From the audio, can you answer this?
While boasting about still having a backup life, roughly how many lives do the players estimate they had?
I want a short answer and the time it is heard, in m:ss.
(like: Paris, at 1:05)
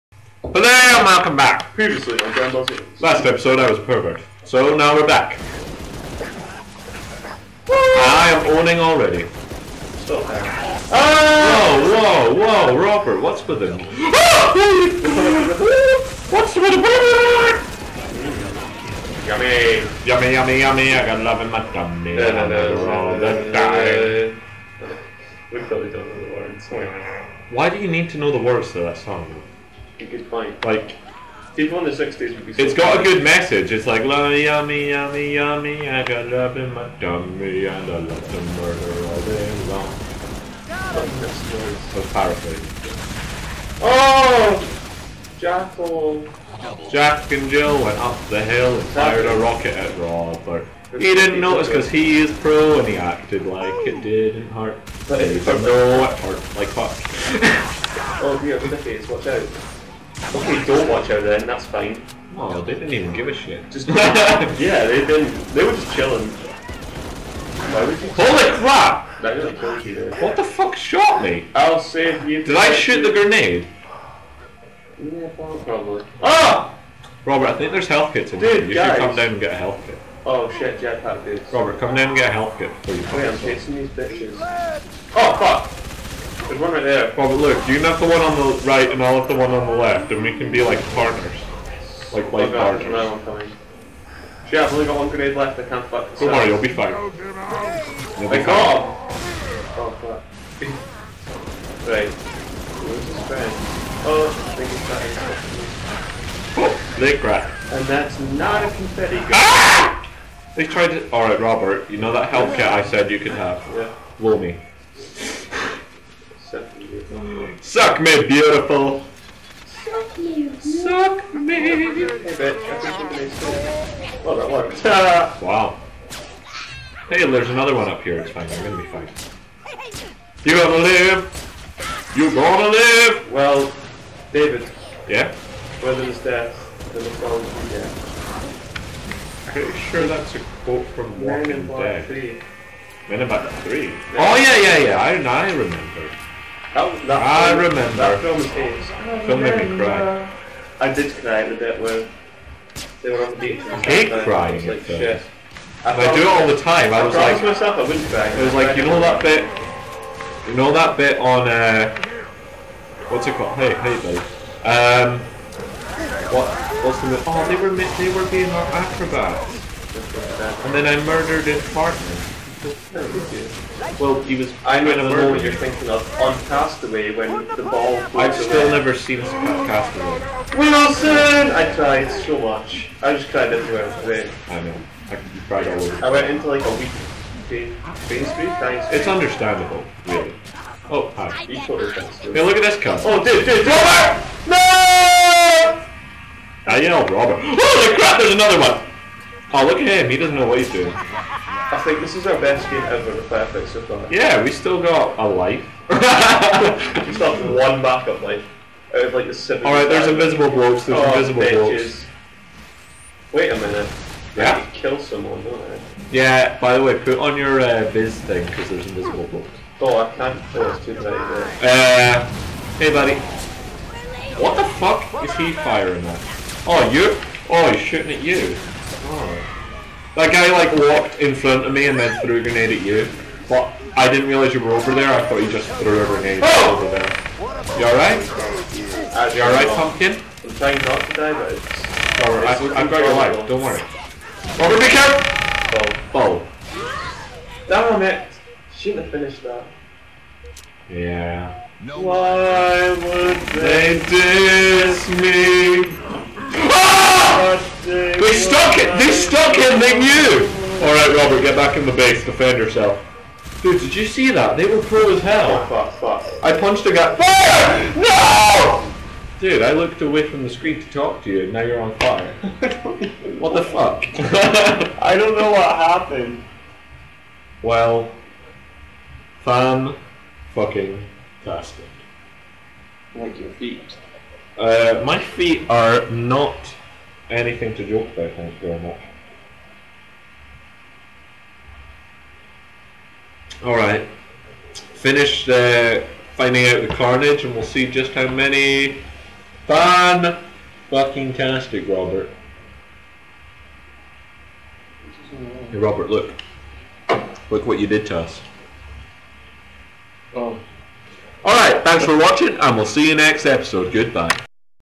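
7, at 3:29.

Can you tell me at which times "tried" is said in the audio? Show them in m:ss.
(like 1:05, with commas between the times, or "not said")
1:50, 3:01.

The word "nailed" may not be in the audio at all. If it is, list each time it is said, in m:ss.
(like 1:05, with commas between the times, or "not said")
not said.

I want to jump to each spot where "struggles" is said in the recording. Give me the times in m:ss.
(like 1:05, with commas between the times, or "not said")
not said.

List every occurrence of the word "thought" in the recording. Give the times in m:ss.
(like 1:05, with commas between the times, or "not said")
3:55.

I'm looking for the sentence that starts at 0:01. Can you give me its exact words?
Previously on Grand Boss Last episode, I was a pervert.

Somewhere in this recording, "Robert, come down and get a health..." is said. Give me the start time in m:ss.
1:21.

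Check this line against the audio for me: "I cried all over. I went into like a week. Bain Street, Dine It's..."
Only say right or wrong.
right.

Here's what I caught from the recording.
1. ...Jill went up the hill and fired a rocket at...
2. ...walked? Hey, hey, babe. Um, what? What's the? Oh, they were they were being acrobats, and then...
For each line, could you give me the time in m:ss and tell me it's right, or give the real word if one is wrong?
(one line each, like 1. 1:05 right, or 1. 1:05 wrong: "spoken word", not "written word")
1. 0:47 right
2. 2:43 wrong: "called", not "walked".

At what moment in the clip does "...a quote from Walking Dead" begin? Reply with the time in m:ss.
2:20.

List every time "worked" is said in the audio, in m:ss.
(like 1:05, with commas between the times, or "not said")
2:04.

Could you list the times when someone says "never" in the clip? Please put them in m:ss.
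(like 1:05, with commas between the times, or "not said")
2:58.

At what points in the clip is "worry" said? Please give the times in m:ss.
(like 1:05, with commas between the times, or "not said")
1:36, 4:03.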